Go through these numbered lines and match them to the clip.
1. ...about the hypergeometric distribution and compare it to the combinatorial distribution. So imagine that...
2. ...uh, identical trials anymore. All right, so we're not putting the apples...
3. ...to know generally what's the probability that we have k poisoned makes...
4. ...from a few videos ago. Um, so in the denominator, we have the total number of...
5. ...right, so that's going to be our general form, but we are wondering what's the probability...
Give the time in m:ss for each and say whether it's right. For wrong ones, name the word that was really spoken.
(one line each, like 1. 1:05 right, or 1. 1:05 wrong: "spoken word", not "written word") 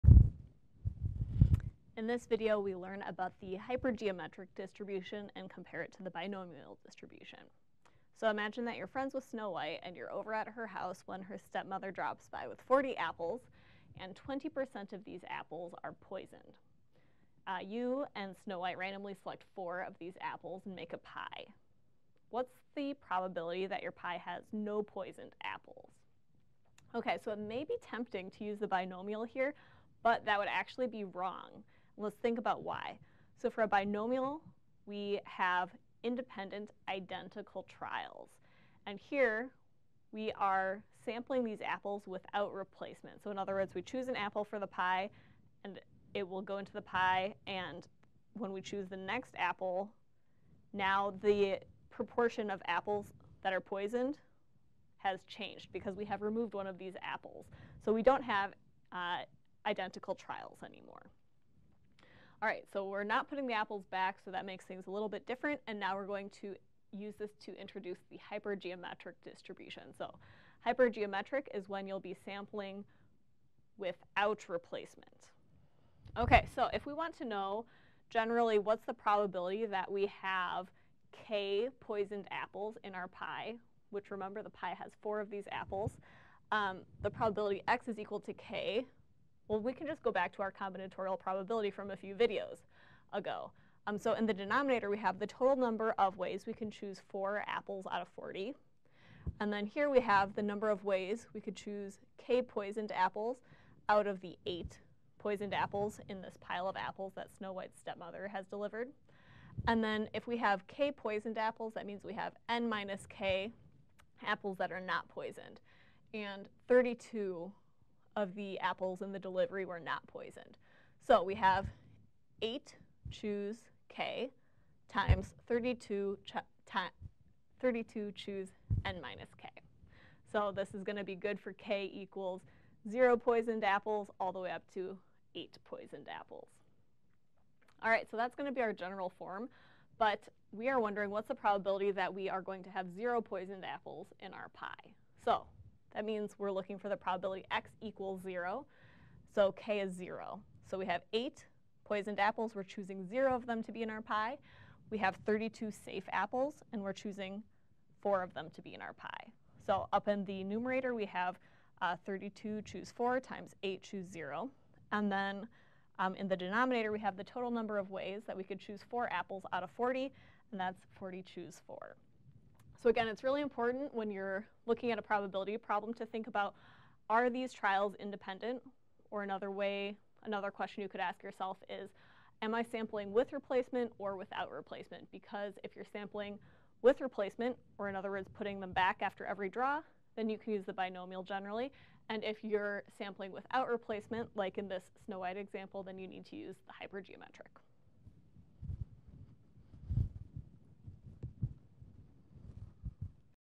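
1. 0:03 wrong: "binomial", not "combinatorial"
2. 0:58 right
3. 1:17 wrong: "apples", not "makes"
4. 1:31 right
5. 2:17 right.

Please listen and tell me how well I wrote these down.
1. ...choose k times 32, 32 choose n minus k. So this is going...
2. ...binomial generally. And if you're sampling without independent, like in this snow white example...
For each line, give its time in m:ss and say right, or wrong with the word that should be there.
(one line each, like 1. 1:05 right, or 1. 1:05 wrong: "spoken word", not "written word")
1. 2:03 right
2. 3:10 wrong: "replacement", not "independent".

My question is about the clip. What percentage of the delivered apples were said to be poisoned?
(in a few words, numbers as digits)
20%.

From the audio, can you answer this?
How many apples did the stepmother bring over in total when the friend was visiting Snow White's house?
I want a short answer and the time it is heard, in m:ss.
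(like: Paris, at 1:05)
40, at 0:12.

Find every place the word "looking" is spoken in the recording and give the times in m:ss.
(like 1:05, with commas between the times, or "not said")
2:26, 2:54.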